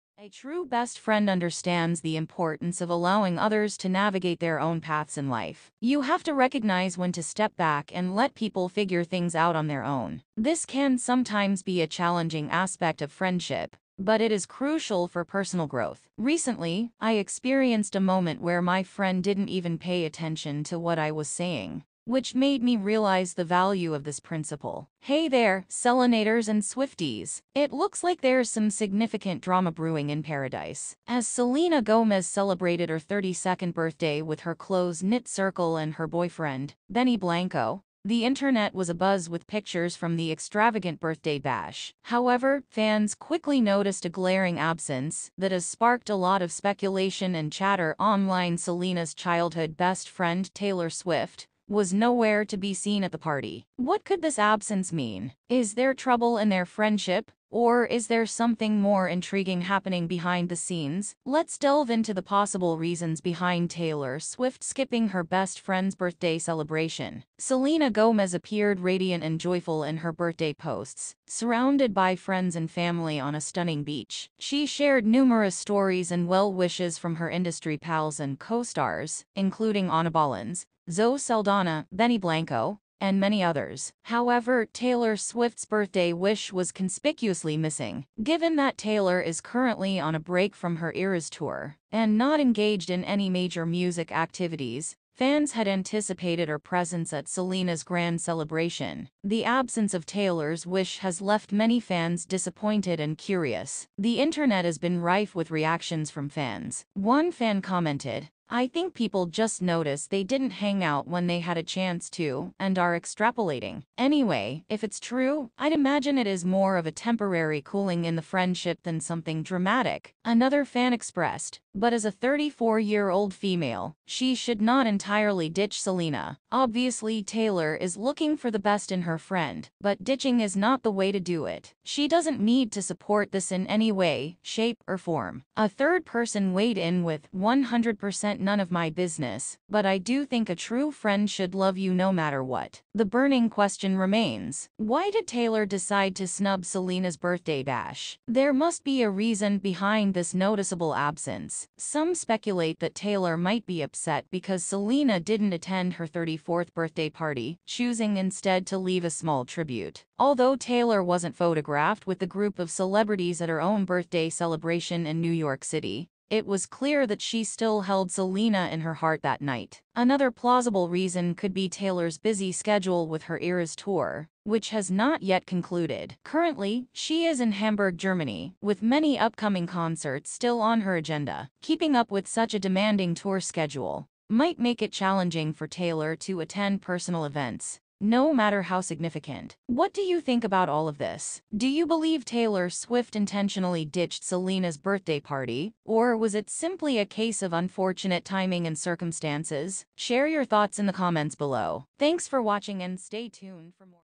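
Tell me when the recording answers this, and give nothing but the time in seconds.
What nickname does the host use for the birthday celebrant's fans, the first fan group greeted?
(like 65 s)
25 s.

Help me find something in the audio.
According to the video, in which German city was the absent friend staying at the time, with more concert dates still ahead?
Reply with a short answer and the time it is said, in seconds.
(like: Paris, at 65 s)
Hamburg, at 177 s.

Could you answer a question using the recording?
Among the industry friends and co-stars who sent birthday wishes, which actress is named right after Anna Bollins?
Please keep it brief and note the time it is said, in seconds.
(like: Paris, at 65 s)
Zoe Saldana, at 80 s.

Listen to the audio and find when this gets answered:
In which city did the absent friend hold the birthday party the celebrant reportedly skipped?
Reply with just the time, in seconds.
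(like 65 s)
165 s.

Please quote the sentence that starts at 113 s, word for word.
Anyway, if it's true, I'd imagine it is more of a temporary cooling in the friendship than something dramatic.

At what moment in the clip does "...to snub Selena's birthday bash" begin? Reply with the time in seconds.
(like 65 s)
146 s.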